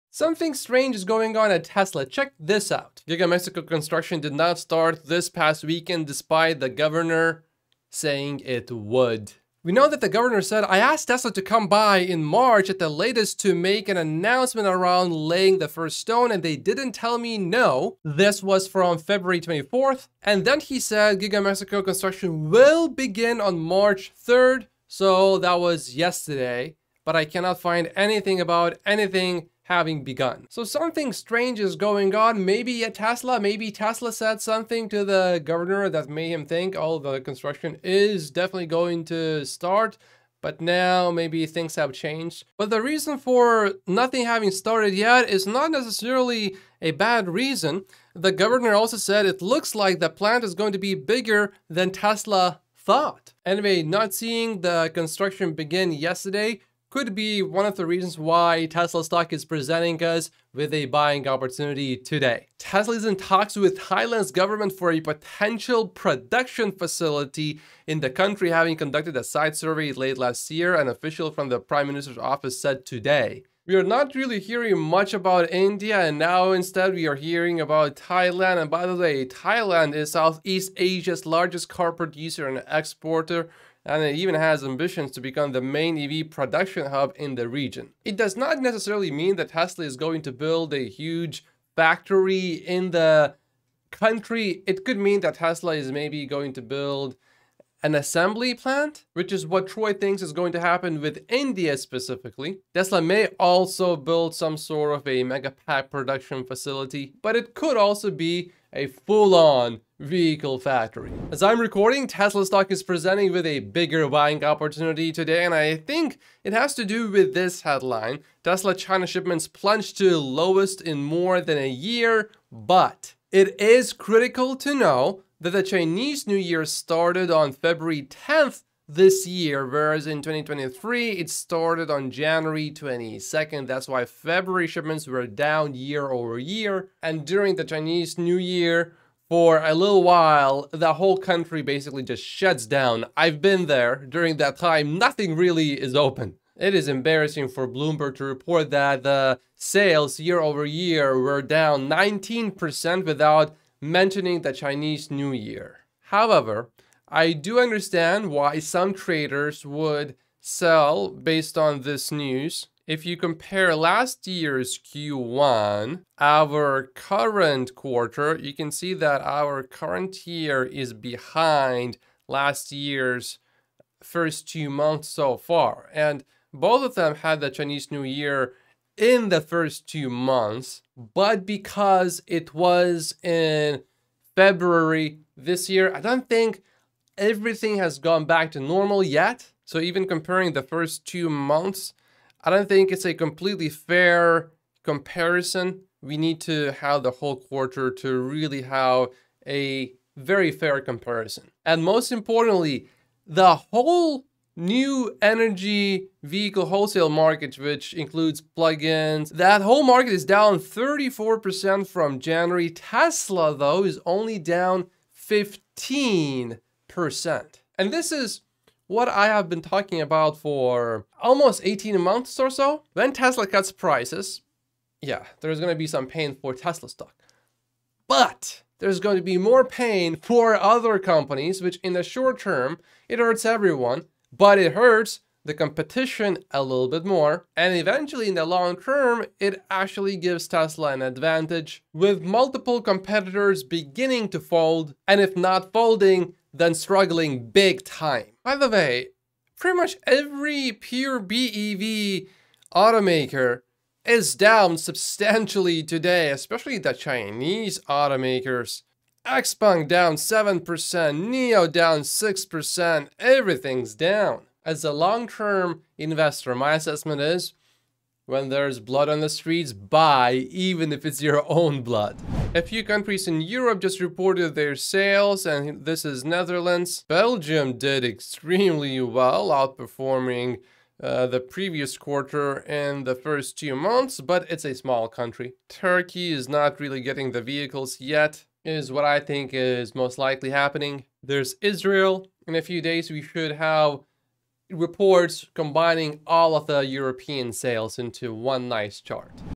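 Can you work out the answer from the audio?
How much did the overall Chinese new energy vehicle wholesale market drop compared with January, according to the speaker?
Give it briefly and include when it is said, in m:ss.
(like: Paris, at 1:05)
34%, at 3:30.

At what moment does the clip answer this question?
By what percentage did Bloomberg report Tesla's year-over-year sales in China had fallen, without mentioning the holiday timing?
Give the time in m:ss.
2:31.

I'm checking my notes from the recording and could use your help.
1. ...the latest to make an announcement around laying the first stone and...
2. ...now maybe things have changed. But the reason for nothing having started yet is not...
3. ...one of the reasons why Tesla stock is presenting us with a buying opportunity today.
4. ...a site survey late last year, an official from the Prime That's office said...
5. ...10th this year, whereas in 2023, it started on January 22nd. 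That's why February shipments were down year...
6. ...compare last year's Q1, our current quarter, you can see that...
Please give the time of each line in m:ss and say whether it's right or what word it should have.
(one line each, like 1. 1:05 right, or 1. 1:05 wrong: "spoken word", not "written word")
1. 0:12 right
2. 0:40 right
3. 0:57 right
4. 1:09 wrong: "Minister", not "That"
5. 2:08 right
6. 2:43 right.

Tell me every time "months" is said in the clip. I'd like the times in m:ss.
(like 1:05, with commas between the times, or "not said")
2:54, 3:00, 3:11, 3:42, 4:43.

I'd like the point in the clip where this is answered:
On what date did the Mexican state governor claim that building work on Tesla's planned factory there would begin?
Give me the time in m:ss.
0:23.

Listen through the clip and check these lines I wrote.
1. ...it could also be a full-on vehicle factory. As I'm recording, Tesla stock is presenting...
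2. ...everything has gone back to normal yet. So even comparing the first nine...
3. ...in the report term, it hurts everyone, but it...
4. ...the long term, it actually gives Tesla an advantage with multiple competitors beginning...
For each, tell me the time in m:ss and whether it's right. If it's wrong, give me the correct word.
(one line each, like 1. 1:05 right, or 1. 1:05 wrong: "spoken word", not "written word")
1. 1:47 right
2. 3:07 wrong: "two", not "nine"
3. 3:51 wrong: "short", not "report"
4. 3:58 right.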